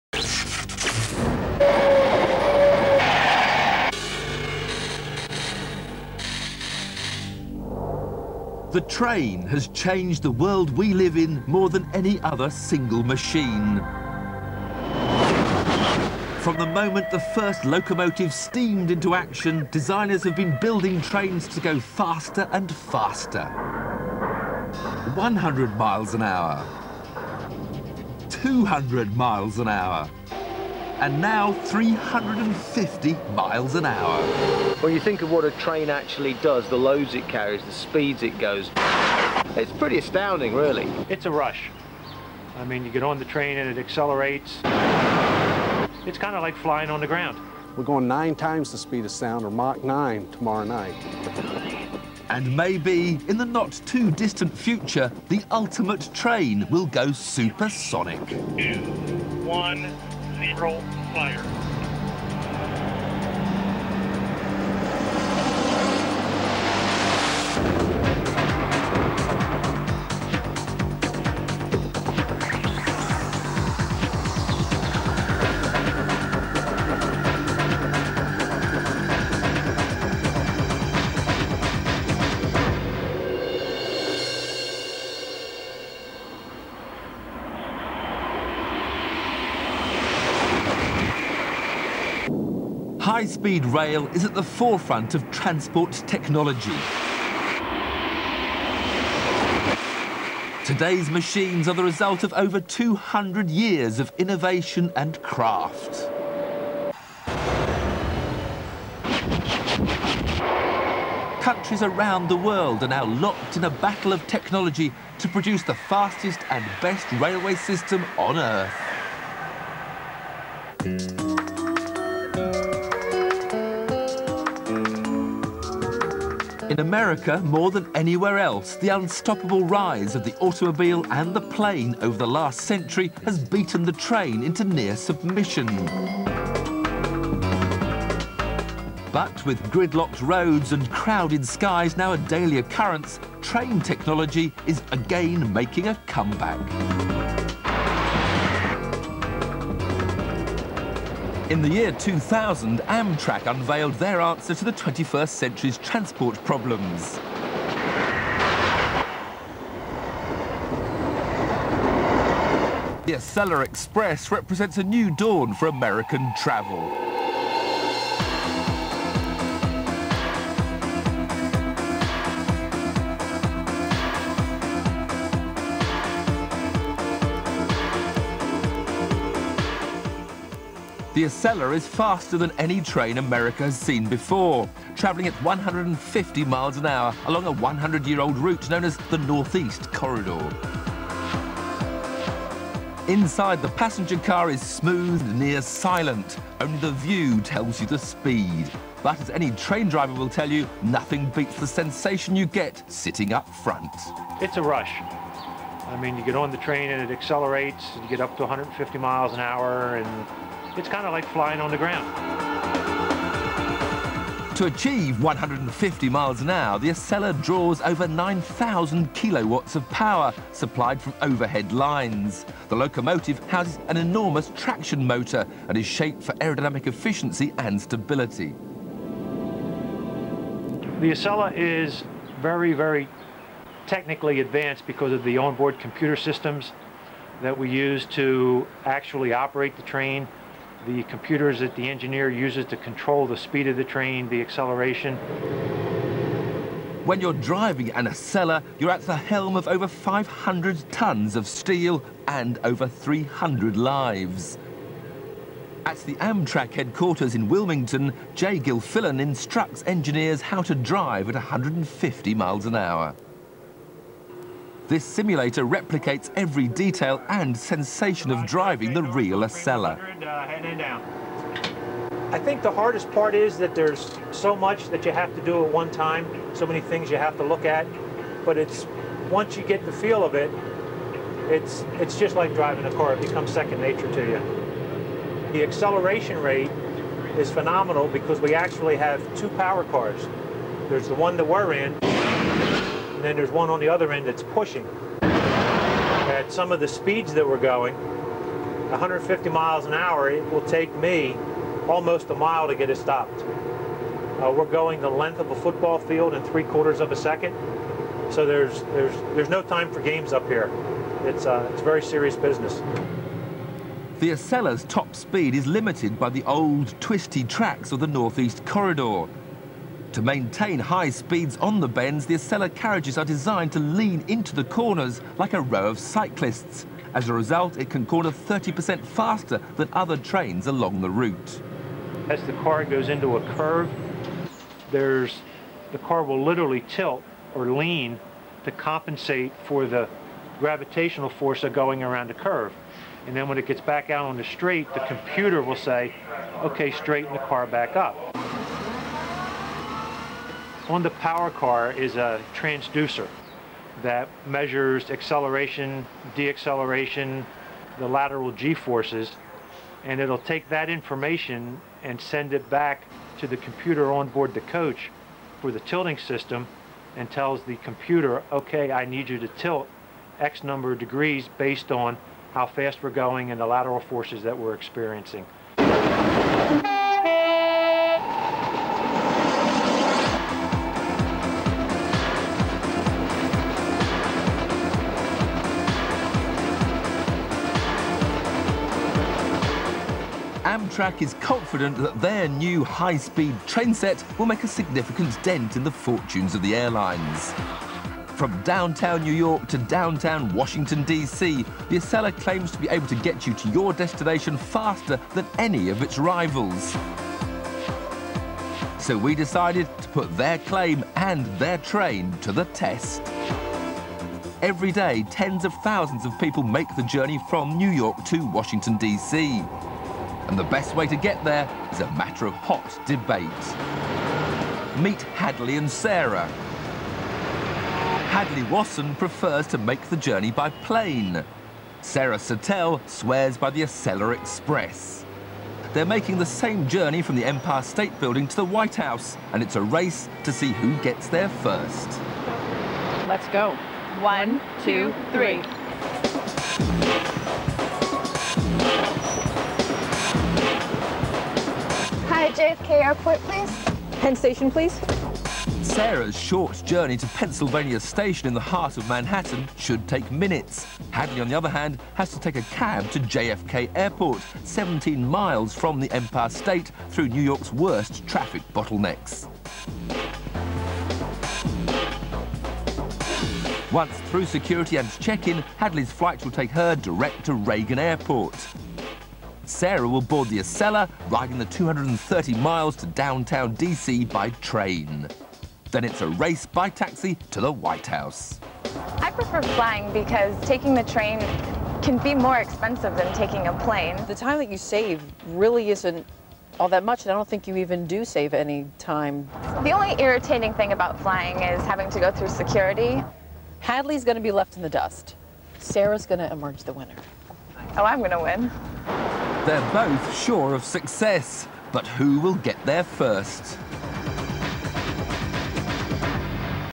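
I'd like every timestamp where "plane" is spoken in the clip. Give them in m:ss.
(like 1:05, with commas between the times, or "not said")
2:11, 7:10, 8:13.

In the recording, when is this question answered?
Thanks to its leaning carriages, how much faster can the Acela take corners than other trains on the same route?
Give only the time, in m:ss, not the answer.
5:28.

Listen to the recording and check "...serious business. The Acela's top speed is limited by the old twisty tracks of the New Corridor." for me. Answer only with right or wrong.
wrong.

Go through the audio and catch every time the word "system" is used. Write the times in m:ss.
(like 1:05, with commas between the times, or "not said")
1:57, 3:56, 6:06.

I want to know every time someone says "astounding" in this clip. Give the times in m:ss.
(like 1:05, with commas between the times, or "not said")
0:39.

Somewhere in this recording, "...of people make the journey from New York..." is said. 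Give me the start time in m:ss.
6:56.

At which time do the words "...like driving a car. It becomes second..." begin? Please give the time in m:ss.
4:42.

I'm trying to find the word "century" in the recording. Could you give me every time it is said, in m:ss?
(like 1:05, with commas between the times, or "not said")
2:12, 2:35.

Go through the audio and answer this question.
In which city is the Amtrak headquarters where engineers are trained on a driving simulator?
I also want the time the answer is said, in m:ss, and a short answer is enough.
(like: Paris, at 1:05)
Wilmington, at 4:17.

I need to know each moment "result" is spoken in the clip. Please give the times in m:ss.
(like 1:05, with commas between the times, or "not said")
1:41, 5:27.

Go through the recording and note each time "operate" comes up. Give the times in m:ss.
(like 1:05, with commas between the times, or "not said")
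3:59.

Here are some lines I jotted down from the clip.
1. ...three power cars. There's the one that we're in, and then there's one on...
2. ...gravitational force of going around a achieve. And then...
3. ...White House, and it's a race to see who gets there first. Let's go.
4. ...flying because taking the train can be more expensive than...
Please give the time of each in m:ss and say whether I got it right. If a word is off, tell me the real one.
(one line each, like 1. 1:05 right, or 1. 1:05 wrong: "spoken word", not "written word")
1. 4:49 wrong: "two", not "three"
2. 5:40 wrong: "curve", not "achieve"
3. 7:18 right
4. 8:09 right.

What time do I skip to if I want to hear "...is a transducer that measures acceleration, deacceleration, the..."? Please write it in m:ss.
5:51.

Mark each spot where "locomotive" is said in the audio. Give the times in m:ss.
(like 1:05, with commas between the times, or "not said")
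0:17, 3:42.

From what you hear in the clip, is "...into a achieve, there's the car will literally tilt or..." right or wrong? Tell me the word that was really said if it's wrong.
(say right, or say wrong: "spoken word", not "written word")
wrong: "curve", not "achieve".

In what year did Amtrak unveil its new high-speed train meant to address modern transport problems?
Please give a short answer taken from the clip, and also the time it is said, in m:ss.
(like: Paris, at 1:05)
2000, at 2:31.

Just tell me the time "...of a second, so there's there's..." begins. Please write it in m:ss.
5:06.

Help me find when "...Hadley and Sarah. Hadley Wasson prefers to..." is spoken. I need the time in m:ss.
7:05.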